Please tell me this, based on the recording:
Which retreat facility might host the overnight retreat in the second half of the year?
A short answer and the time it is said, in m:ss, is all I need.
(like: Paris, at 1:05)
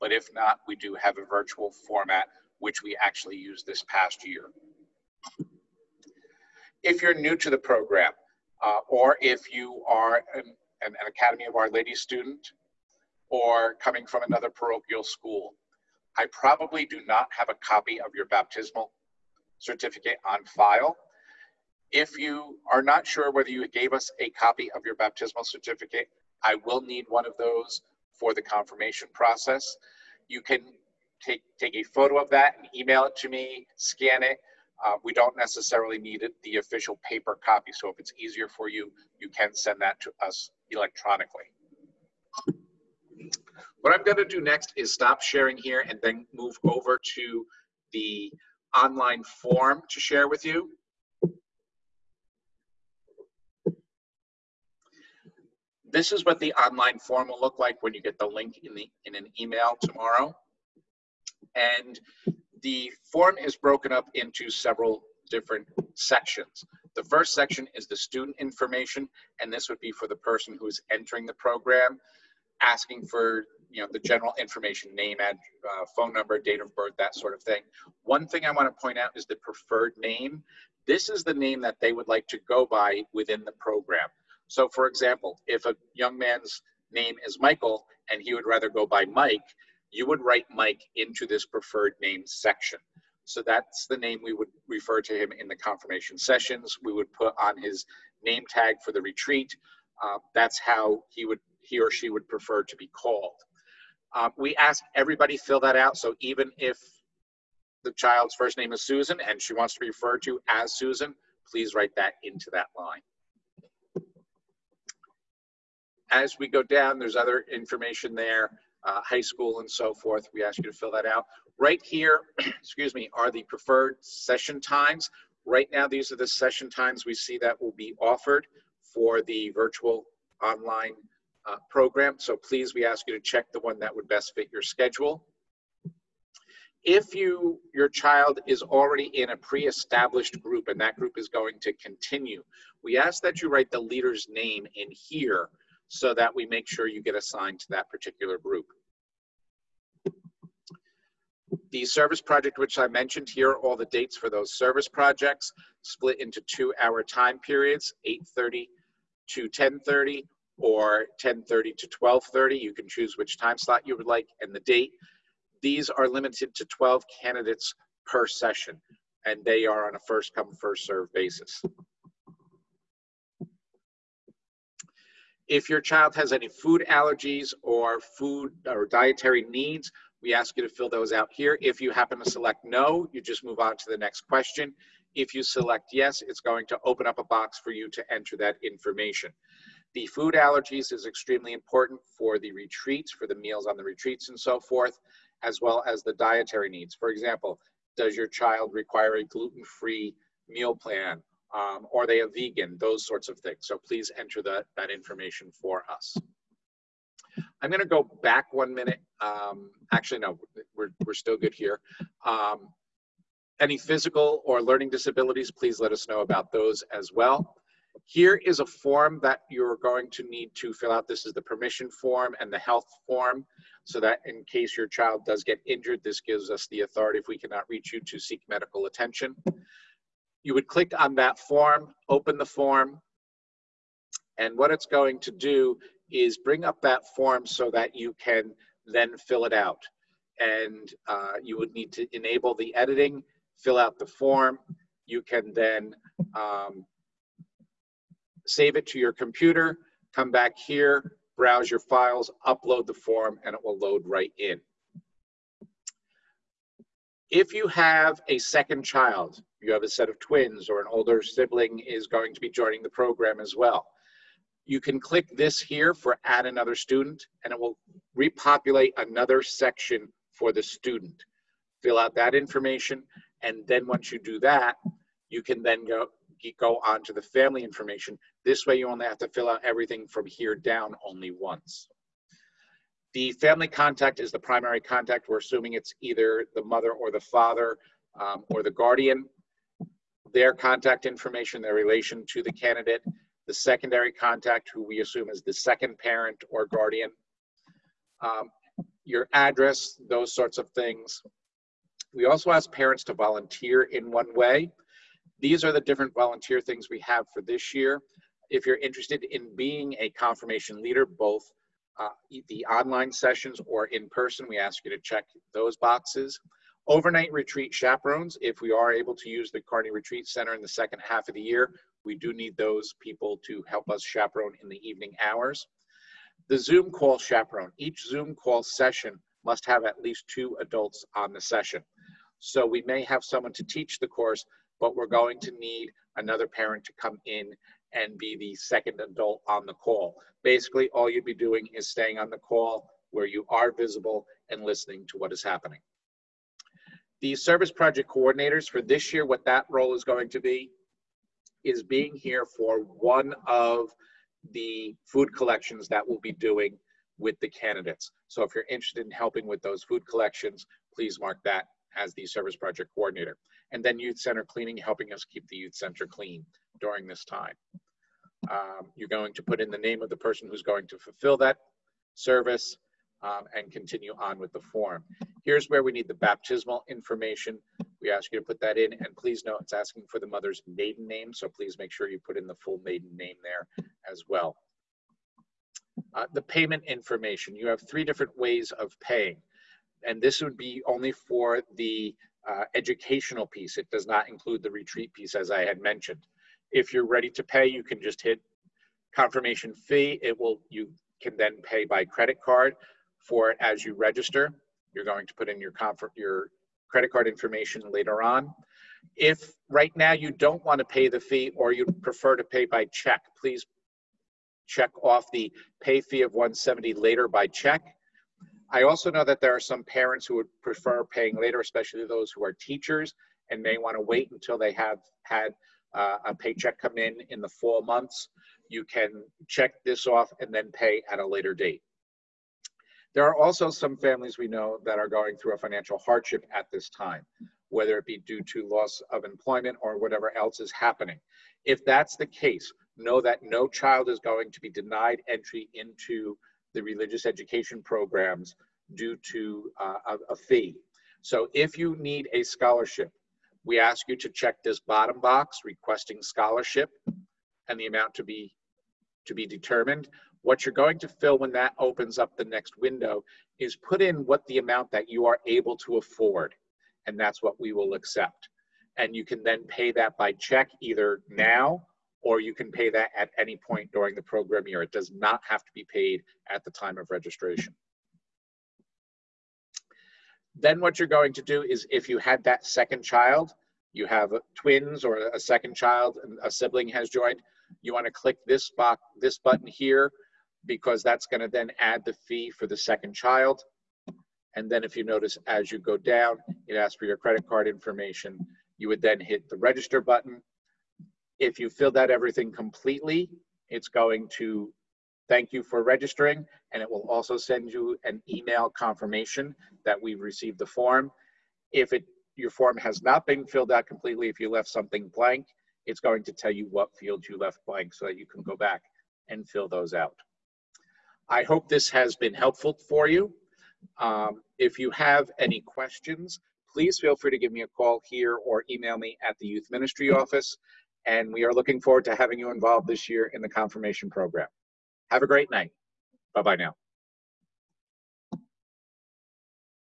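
Carney Retreat Center, at 5:19.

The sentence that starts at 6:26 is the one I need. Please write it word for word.
Uh, the payment information, you have three different ways of paying, and this would be only for the uh, educational piece.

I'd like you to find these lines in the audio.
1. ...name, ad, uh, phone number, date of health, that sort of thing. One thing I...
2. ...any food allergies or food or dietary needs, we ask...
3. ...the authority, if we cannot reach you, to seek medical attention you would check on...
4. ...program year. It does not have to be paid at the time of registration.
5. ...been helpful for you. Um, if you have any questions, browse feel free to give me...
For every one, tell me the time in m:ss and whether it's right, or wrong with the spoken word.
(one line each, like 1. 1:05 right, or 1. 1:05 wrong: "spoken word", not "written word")
1. 1:14 wrong: "birth", not "health"
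2. 2:56 right
3. 3:46 wrong: "click", not "check"
4. 7:54 right
5. 8:42 wrong: "please", not "browse".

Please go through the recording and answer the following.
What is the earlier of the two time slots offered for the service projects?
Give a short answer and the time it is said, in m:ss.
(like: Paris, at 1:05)
8:30 to 10:30, at 2:38.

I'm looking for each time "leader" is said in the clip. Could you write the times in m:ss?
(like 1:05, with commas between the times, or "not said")
2:23, 5:10.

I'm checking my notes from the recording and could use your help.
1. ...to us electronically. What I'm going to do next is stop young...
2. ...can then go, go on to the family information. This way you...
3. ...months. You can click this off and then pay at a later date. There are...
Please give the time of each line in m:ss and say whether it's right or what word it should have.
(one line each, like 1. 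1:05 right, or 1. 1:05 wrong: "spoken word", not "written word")
1. 0:40 wrong: "sharing", not "young"
2. 4:35 right
3. 7:07 wrong: "check", not "click".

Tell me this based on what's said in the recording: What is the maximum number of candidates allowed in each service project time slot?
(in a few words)
12.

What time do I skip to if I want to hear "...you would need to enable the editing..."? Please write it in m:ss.
4:01.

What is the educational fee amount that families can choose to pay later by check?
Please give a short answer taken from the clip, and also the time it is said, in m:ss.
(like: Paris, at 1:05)
170, at 6:56.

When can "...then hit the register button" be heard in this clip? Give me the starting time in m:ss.
8:19.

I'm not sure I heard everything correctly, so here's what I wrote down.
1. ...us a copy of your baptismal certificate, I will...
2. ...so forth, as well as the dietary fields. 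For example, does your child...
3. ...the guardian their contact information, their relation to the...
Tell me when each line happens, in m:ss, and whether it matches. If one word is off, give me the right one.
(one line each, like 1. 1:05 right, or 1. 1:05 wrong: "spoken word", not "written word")
1. 0:23 right
2. 3:14 wrong: "needs", not "fields"
3. 4:48 right.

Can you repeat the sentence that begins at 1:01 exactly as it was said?
And the form is broken up into several different sections.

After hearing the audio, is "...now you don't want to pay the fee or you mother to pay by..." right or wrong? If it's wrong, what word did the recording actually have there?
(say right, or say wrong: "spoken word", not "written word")
wrong: "prefer", not "mother".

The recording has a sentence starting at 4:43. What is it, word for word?
The family contact is the primary contact.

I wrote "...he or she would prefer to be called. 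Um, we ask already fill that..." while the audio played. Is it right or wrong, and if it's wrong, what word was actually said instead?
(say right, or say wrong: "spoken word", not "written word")
wrong: "everybody", not "already".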